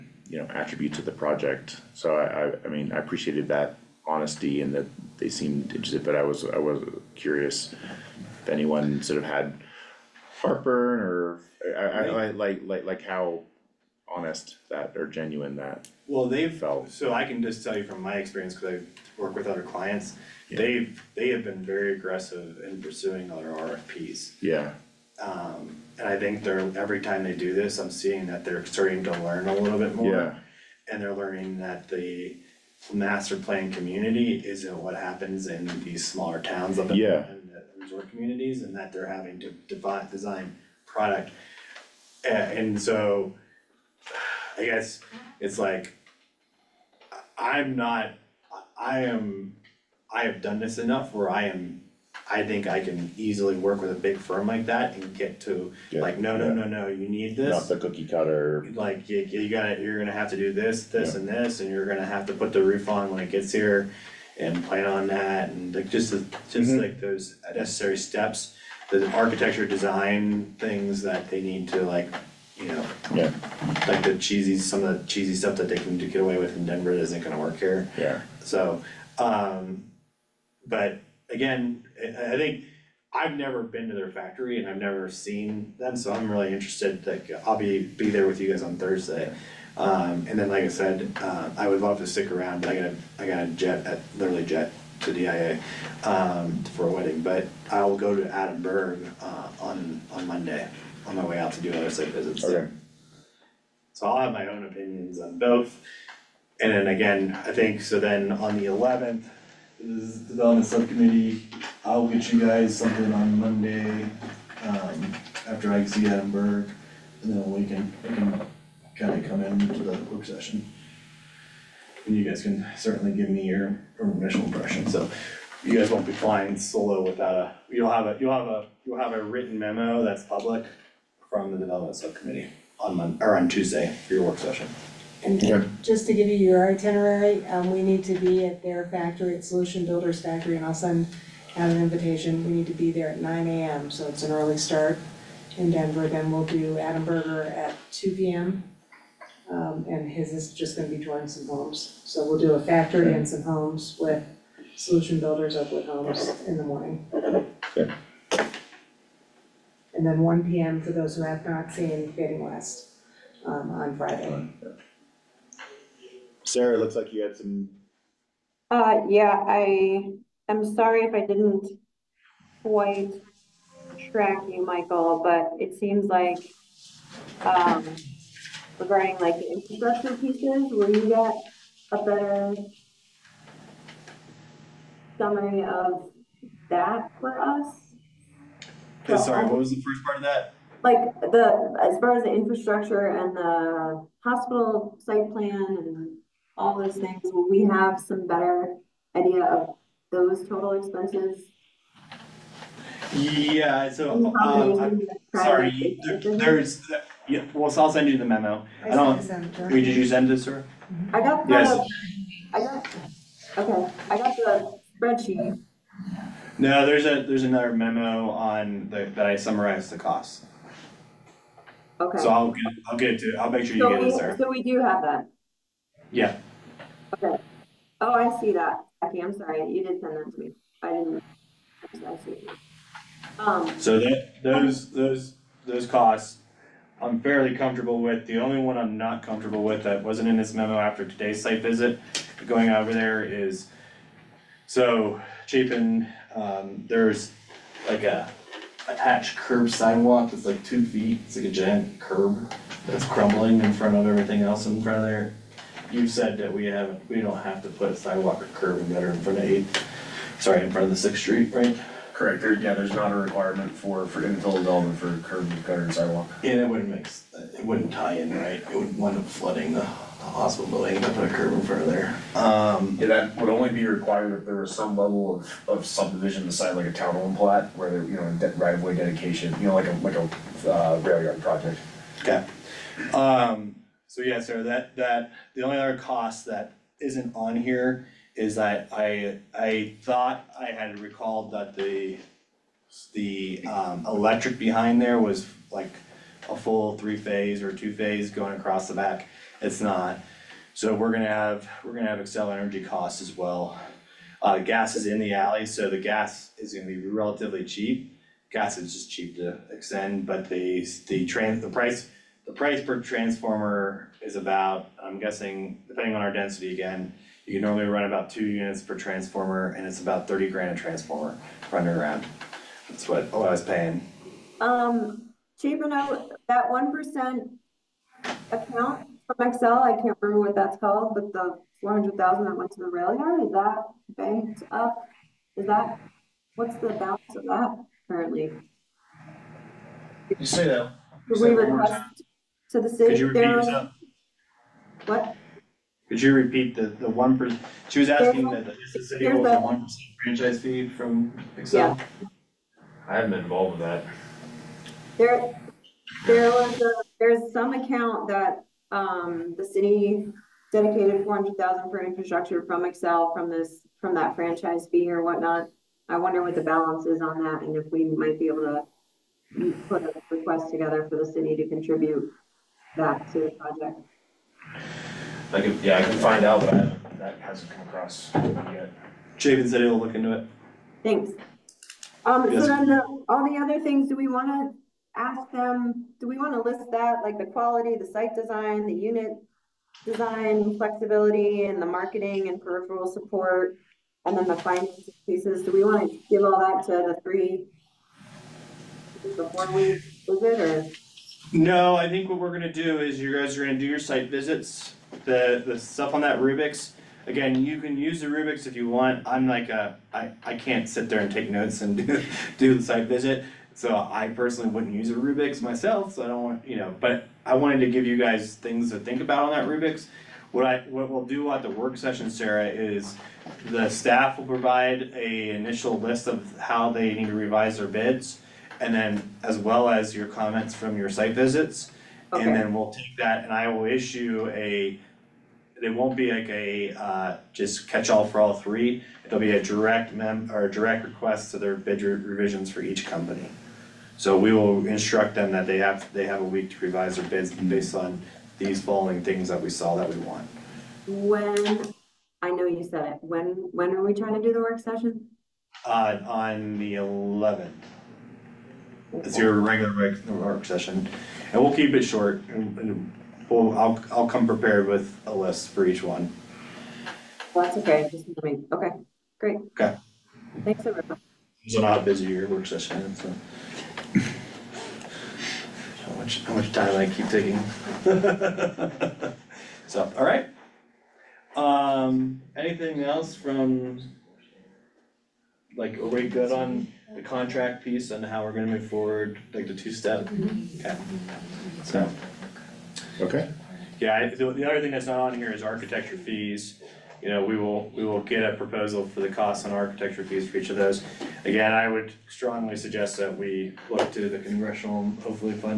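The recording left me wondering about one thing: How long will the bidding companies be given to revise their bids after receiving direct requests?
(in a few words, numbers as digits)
a week.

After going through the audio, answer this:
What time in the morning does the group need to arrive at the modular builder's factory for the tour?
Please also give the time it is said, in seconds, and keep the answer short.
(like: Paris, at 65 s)
9 AM, at 143 s.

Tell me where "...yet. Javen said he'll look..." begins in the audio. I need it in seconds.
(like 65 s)
378 s.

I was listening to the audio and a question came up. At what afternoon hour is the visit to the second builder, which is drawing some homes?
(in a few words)
2 PM.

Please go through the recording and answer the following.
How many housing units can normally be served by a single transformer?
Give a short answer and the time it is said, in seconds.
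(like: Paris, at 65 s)
2, at 318 s.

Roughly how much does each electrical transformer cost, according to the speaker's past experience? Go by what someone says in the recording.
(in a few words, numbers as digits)
30 grand.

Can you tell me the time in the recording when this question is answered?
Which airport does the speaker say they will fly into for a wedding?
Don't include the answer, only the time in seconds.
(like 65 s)
95 s.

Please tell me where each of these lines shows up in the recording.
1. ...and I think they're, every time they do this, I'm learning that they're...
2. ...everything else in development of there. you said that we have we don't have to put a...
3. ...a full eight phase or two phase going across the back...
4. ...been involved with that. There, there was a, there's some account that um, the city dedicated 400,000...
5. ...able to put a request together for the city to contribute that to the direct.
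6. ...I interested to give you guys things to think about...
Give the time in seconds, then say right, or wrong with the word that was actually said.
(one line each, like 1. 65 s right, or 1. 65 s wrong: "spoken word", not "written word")
1. 25 s wrong: "seeing", not "learning"
2. 254 s wrong: "front", not "development"
3. 296 s wrong: "three", not "eight"
4. 353 s right
5. 368 s wrong: "project", not "direct"
6. 417 s wrong: "wanted", not "interested".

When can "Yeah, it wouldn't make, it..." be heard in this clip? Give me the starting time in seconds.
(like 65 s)
266 s.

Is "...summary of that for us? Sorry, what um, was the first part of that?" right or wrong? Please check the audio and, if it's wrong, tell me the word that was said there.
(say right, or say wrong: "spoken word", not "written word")
right.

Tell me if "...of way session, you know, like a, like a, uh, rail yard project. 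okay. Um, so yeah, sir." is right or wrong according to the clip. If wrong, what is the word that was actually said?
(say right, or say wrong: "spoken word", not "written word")
wrong: "dedication", not "session".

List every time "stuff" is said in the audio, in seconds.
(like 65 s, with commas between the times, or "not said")
75 s, 405 s.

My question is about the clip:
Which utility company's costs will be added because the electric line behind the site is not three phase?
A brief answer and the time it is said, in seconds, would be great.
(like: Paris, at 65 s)
Xcel Energy, at 302 s.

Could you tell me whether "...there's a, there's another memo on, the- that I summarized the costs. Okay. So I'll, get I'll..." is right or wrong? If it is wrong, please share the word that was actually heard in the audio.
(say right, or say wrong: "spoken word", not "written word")
right.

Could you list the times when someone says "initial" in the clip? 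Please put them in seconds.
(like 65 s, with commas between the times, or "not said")
124 s, 425 s.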